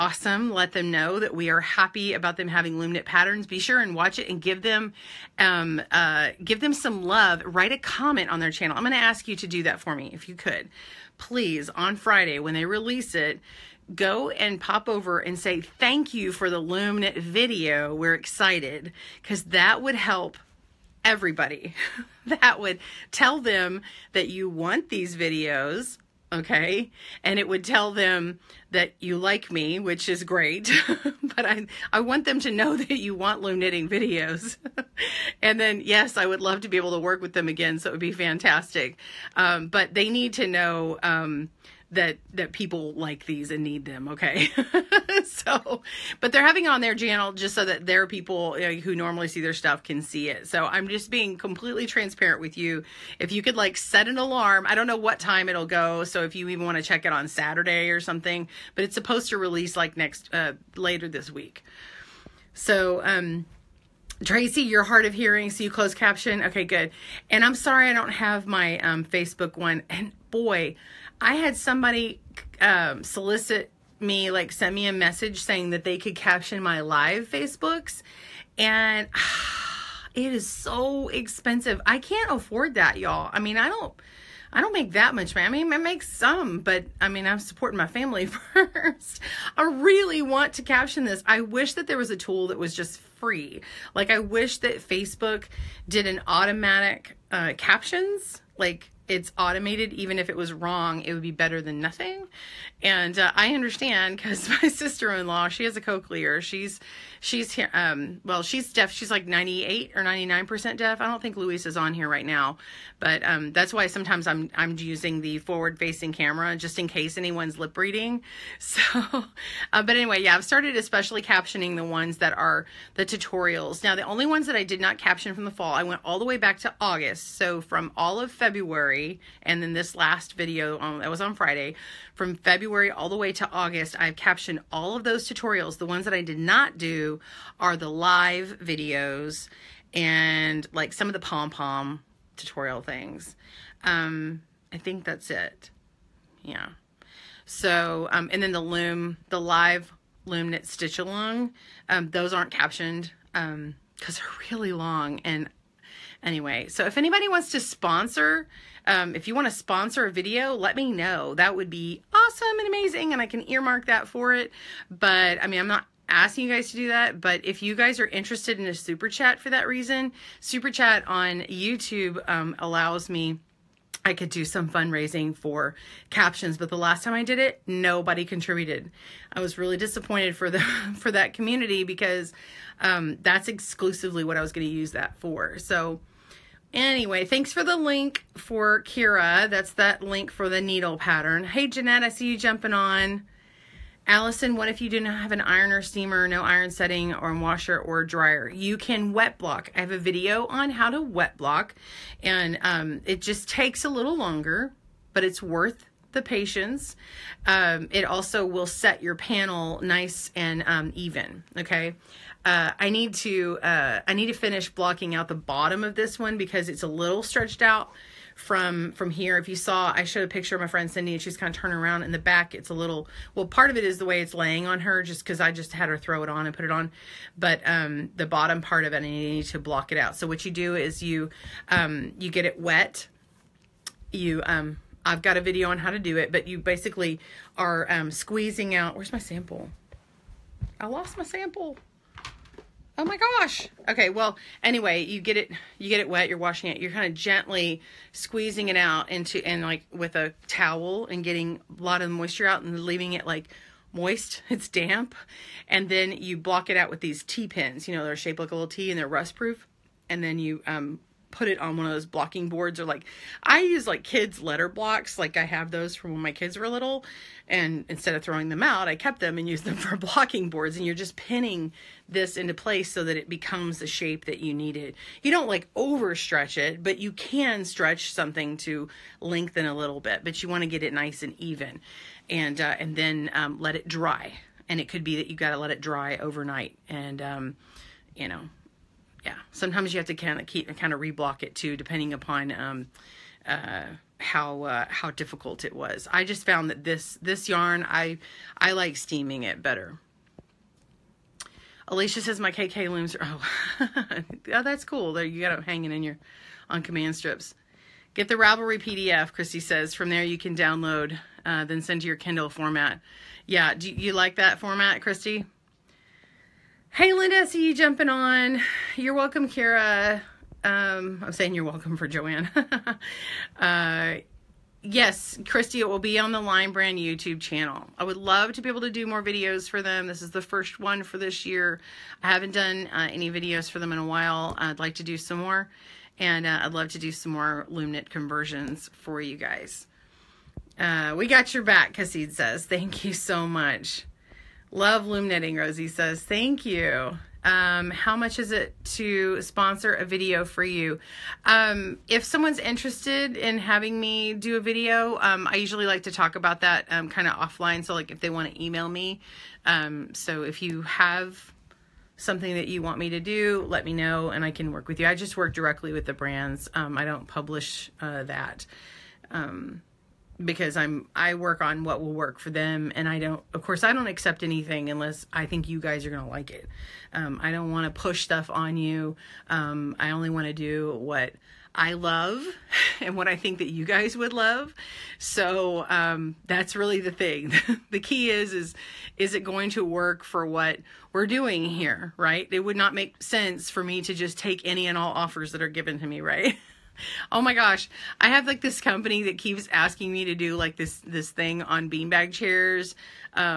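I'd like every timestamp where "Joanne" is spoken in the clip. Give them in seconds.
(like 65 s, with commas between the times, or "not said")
322 s.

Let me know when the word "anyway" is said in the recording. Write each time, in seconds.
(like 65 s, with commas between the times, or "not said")
119 s, 156 s, 186 s, 244 s.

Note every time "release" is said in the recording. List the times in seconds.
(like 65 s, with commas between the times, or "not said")
12 s, 59 s.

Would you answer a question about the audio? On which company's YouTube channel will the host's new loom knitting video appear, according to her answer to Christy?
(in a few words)
Lion Brand.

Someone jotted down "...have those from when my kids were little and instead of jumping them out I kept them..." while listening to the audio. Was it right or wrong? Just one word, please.
wrong.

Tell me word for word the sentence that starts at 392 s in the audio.
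It would not make sense for me to just take any and all offers that are given to me, right?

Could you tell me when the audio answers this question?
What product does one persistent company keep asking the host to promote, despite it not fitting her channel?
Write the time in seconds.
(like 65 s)
401 s.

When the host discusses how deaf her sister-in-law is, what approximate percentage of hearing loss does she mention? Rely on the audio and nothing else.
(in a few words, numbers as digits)
98 or 99%.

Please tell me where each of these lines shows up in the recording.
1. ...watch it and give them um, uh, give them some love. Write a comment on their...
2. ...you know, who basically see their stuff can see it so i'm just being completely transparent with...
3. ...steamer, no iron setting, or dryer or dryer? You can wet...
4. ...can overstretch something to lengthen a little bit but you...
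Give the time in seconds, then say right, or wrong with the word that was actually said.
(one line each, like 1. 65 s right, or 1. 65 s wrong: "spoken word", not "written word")
1. 3 s right
2. 48 s wrong: "normally", not "basically"
3. 195 s wrong: "washer", not "dryer"
4. 277 s wrong: "stretch", not "overstretch".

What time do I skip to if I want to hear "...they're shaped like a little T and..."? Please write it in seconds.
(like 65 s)
258 s.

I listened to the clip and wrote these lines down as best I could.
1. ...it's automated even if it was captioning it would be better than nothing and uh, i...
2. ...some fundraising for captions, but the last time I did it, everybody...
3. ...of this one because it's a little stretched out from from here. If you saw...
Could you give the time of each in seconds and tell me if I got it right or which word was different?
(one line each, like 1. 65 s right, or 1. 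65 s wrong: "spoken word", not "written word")
1. 99 s wrong: "wrong", not "captioning"
2. 174 s wrong: "nobody", not "everybody"
3. 215 s right.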